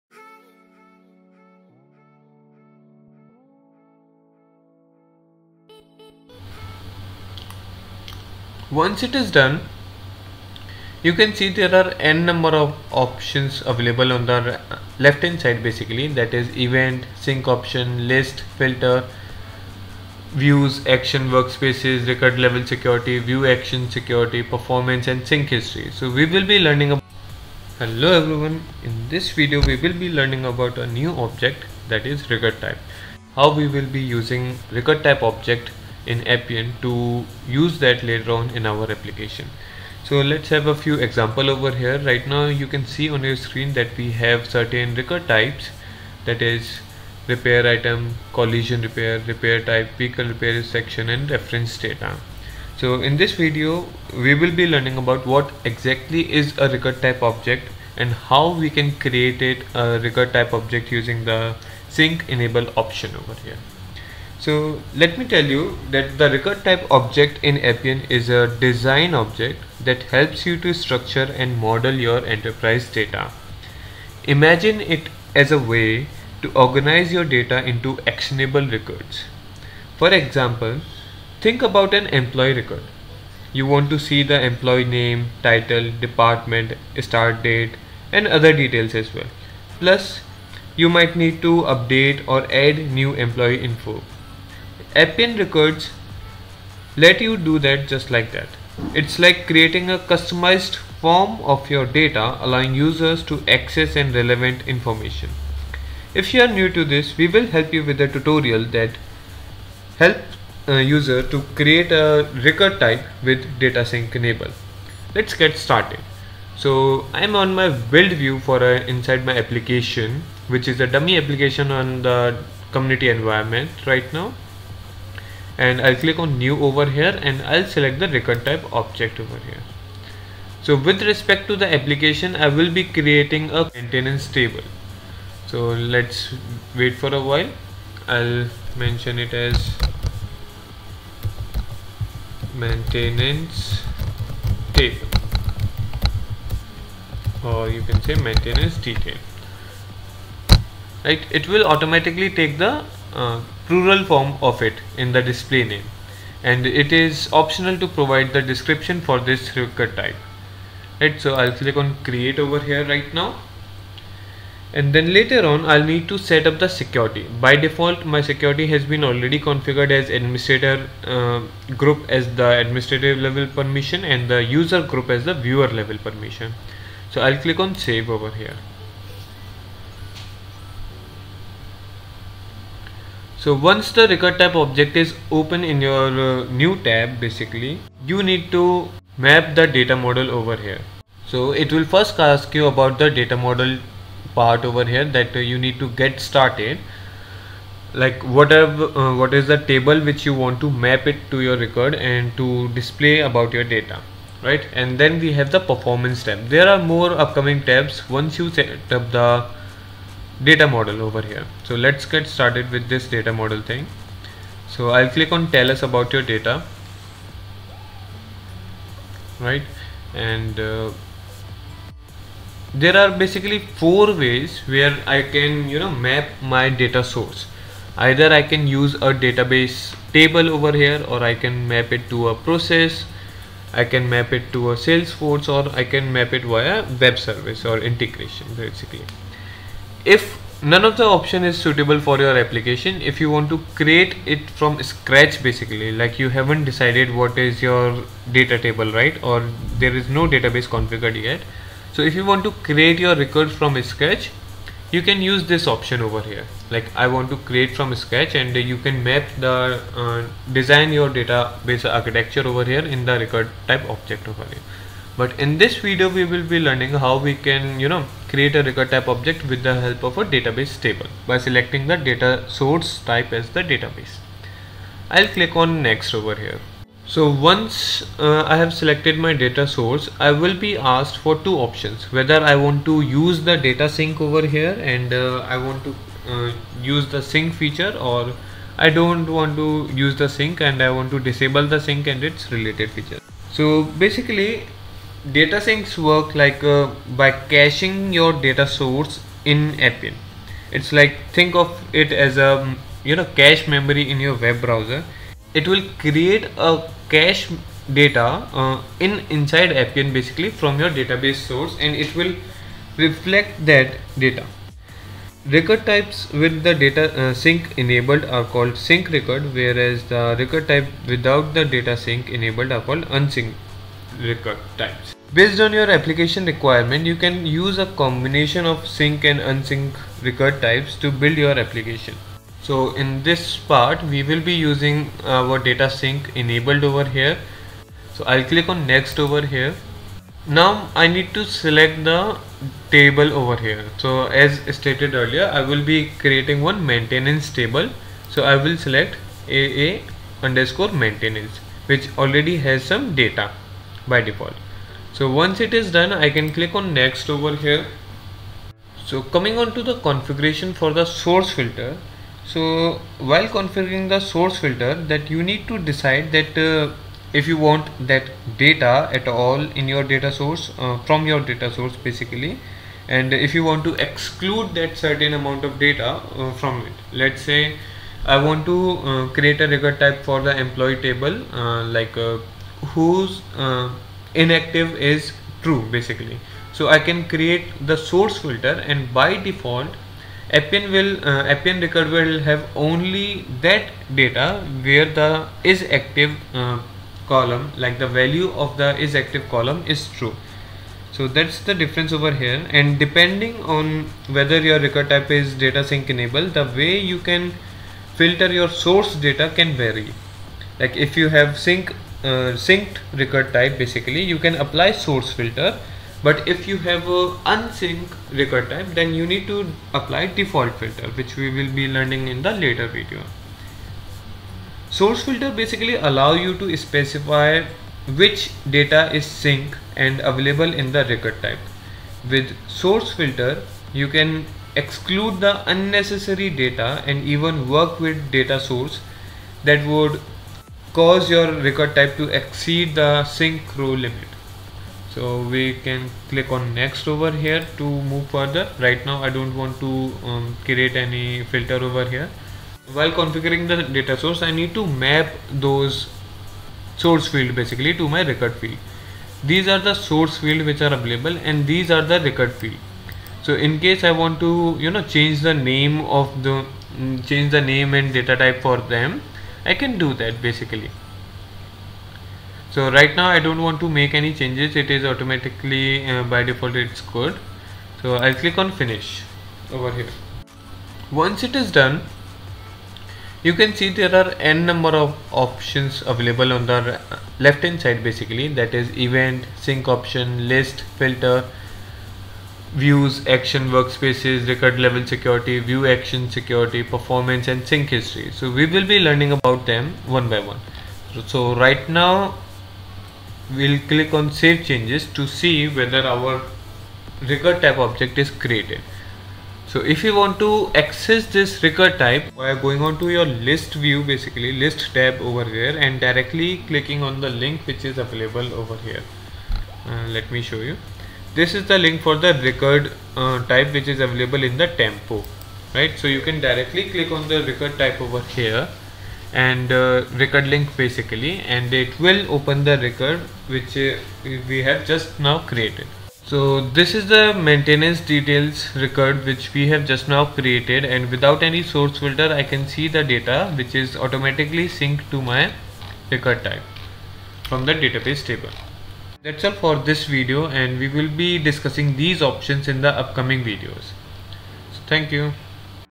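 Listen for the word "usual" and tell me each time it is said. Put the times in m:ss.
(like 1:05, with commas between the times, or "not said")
not said.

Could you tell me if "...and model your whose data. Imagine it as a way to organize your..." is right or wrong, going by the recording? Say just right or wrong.
wrong.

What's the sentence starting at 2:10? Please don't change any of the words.
So with respect to the application, I will be creating a maintenance table.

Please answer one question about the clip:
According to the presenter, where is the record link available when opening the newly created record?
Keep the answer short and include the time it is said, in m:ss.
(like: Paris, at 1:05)
tempo, at 8:44.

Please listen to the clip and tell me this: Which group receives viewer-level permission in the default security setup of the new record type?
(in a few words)
user group.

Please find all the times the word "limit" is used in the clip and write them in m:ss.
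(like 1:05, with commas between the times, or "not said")
7:23.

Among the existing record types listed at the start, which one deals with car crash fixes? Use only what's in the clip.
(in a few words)
collision repair.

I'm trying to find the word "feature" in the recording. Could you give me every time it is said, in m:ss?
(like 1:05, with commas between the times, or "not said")
4:47, 4:52.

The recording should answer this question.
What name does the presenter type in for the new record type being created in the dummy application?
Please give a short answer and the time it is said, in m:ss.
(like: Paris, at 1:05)
maintenance detail, at 2:28.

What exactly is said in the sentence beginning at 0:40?
So let's have a few example over here.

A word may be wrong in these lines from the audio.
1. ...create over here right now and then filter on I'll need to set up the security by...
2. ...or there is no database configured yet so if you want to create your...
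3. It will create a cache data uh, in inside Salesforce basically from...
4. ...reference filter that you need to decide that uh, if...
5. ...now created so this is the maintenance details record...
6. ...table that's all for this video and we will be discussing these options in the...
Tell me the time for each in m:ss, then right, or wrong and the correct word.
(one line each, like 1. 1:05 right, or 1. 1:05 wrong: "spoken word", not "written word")
1. 2:42 wrong: "later", not "filter"
2. 4:09 right
3. 5:05 wrong: "Appian", not "Salesforce"
4. 6:04 wrong: "source", not "reference"
5. 8:55 right
6. 9:08 right.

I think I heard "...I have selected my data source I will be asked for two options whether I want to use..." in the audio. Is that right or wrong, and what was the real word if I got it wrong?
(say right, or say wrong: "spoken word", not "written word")
right.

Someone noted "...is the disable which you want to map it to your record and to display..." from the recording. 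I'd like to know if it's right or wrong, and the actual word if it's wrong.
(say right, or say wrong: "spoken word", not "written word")
wrong: "table", not "disable".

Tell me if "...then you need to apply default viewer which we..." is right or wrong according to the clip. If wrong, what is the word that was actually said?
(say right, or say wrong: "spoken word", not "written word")
wrong: "filter", not "viewer".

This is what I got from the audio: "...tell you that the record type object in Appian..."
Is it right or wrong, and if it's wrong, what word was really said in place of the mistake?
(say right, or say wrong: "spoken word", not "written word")
right.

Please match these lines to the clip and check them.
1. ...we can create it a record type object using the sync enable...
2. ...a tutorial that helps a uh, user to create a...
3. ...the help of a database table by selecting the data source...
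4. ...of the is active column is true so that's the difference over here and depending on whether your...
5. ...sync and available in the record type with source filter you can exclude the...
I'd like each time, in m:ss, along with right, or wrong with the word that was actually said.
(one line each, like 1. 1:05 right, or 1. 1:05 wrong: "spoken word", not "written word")
1. 0:58 right
2. 1:48 right
3. 4:29 right
4. 6:38 right
5. 7:09 right.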